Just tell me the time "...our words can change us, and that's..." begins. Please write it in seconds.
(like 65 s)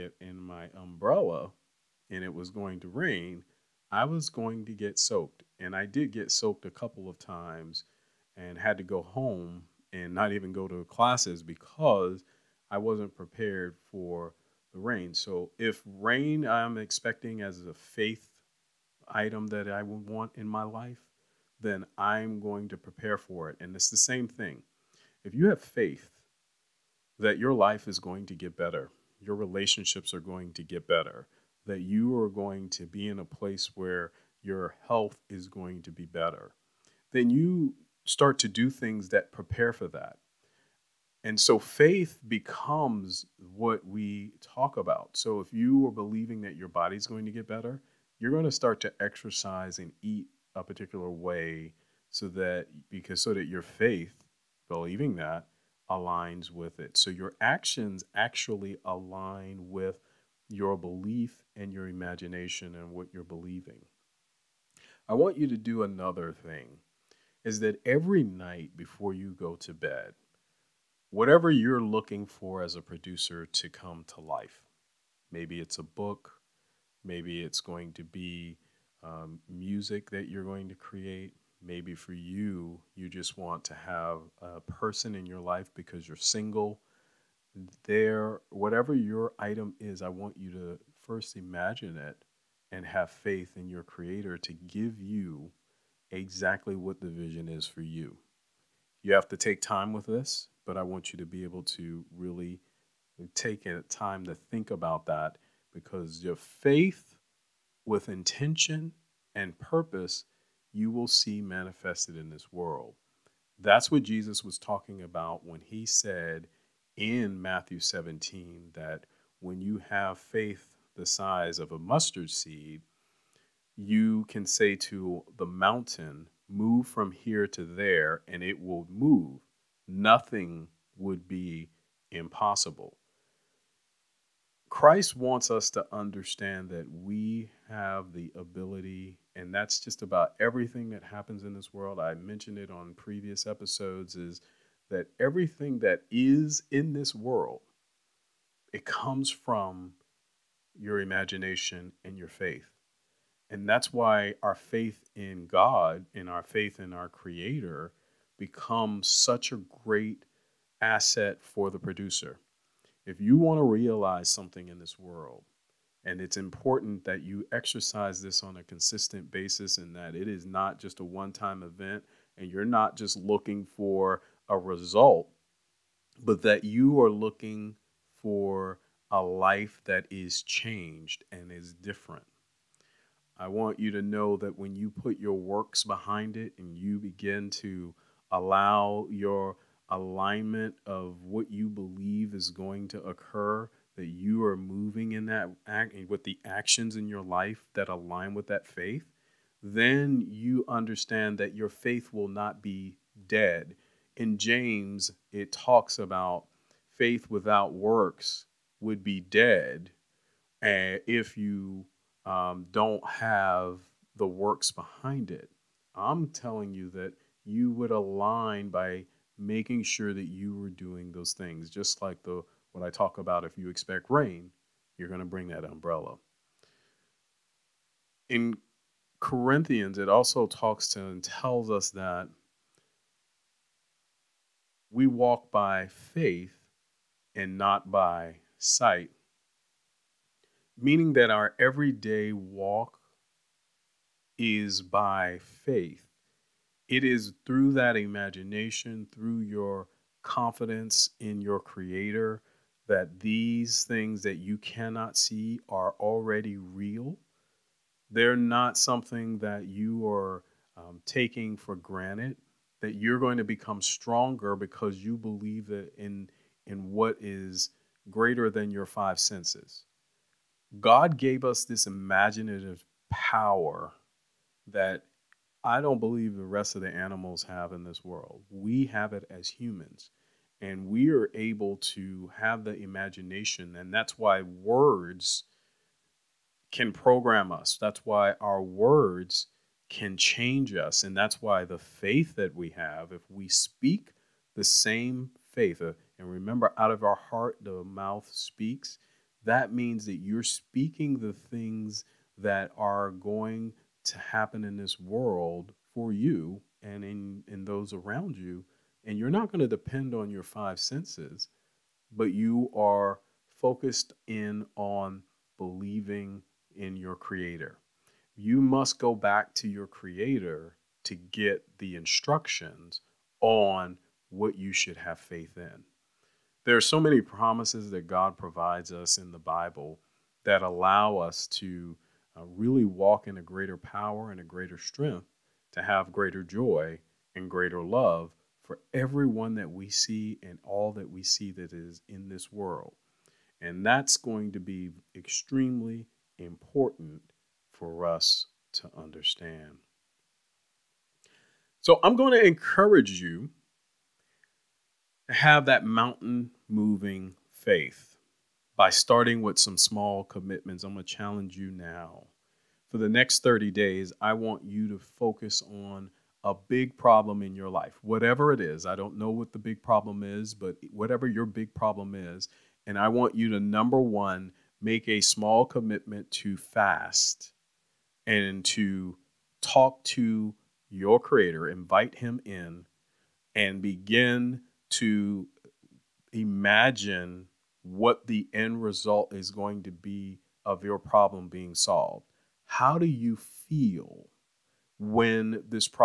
288 s.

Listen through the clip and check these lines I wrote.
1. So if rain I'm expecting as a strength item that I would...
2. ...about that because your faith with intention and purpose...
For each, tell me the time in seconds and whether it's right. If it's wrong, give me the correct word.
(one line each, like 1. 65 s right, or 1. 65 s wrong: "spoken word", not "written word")
1. 15 s wrong: "faith", not "strength"
2. 104 s right.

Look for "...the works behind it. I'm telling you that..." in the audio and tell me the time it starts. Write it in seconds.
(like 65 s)
214 s.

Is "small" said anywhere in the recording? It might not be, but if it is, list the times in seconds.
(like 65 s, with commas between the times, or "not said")
359 s, 375 s.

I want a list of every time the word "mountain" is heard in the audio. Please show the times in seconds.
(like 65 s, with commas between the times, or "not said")
125 s, 355 s.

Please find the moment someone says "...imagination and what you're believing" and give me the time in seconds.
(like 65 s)
61 s.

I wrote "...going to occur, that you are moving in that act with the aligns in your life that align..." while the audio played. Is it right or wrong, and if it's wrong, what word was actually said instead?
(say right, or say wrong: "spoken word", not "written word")
wrong: "actions", not "aligns".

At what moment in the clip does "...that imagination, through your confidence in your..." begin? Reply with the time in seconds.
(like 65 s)
247 s.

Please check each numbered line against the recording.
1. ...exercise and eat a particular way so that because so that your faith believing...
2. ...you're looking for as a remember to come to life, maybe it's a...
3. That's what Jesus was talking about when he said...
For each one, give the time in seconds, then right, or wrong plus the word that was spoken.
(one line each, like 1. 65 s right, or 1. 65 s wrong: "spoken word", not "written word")
1. 49 s right
2. 71 s wrong: "producer", not "remember"
3. 113 s right.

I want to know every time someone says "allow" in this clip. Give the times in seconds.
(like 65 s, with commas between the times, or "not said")
188 s, 330 s.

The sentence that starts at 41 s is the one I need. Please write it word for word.
And so faith becomes what we talk about.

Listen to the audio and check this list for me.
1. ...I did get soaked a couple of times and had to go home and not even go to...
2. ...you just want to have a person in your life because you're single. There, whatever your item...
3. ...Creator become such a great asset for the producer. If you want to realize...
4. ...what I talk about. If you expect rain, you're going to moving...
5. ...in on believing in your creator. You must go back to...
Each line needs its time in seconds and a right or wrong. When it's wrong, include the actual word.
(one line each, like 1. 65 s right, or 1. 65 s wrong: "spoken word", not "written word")
1. 5 s right
2. 82 s right
3. 157 s right
4. 222 s wrong: "bring", not "moving"
5. 314 s right.